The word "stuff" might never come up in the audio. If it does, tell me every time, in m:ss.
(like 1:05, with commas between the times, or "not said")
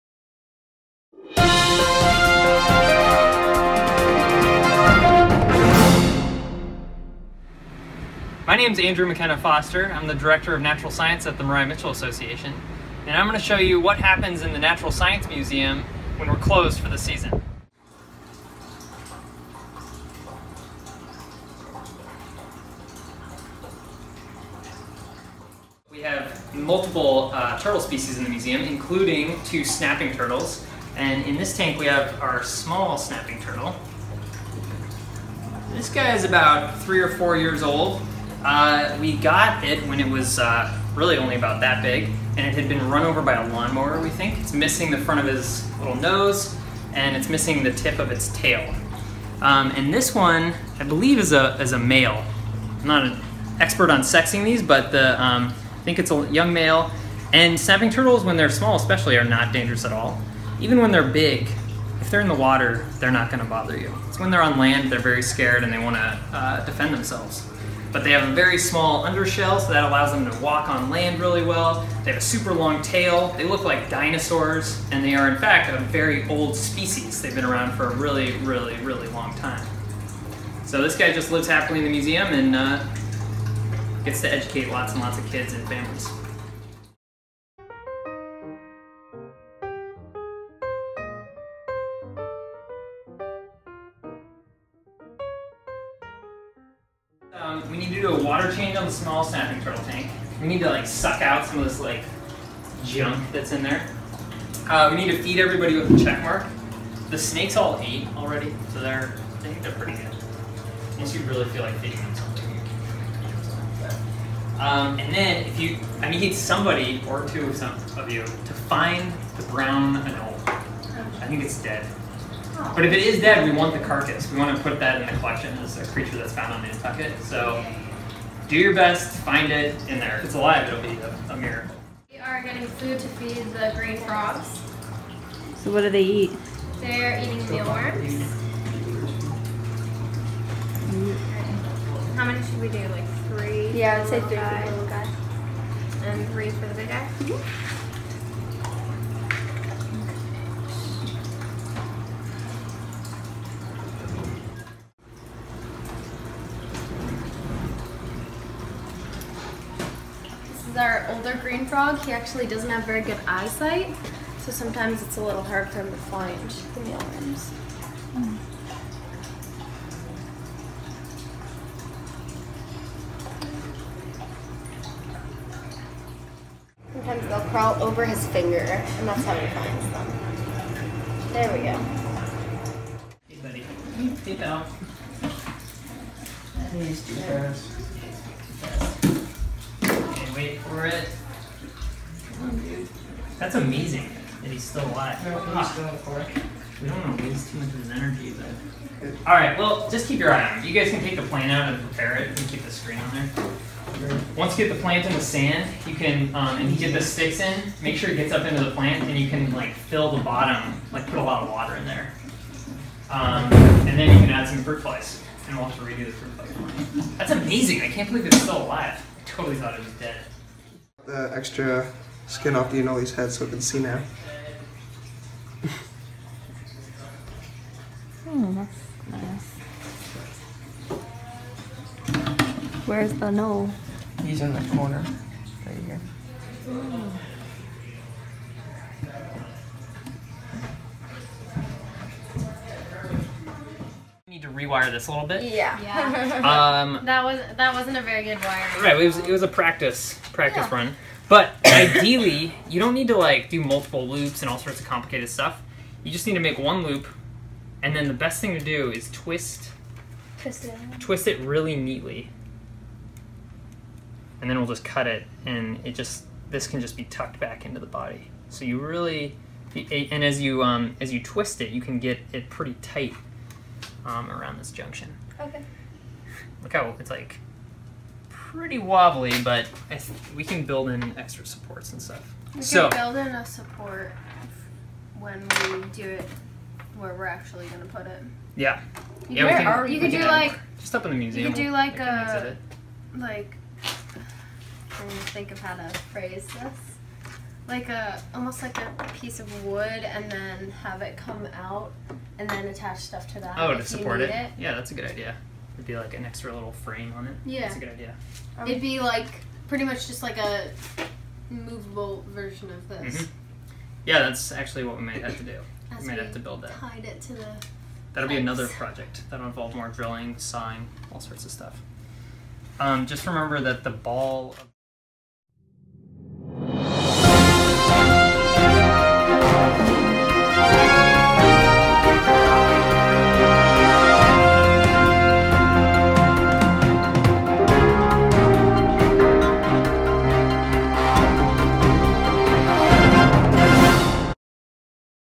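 4:15, 4:42, 5:02, 5:21.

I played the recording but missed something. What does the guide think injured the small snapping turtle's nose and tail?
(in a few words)
A lawnmower.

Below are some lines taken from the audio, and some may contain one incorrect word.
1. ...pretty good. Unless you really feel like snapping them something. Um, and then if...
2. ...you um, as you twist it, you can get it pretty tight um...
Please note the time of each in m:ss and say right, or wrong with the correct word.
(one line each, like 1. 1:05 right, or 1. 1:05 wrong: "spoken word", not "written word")
1. 1:49 wrong: "feeding", not "snapping"
2. 4:30 right.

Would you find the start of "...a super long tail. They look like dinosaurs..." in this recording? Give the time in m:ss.
1:12.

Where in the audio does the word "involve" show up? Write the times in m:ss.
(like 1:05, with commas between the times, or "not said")
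5:19.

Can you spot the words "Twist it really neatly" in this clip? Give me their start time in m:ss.
4:20.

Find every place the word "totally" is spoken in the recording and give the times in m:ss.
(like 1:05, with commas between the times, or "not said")
3:39.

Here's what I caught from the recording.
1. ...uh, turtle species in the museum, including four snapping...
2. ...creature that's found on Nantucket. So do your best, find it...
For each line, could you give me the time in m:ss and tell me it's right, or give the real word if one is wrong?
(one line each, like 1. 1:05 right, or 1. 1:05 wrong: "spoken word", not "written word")
1. 0:27 wrong: "two", not "four"
2. 2:05 right.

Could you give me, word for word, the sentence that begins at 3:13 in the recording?
That's amazing that he's still alive.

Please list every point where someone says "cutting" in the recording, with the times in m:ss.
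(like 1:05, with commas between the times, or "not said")
not said.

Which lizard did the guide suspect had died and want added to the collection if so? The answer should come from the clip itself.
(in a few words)
Brown anole.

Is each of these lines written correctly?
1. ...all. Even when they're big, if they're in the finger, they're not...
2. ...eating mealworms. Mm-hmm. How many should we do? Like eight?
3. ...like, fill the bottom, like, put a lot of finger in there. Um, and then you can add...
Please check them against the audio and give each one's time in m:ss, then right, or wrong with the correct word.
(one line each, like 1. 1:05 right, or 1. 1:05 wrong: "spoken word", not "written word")
1. 0:59 wrong: "water", not "finger"
2. 2:17 wrong: "three", not "eight"
3. 3:29 wrong: "water", not "finger".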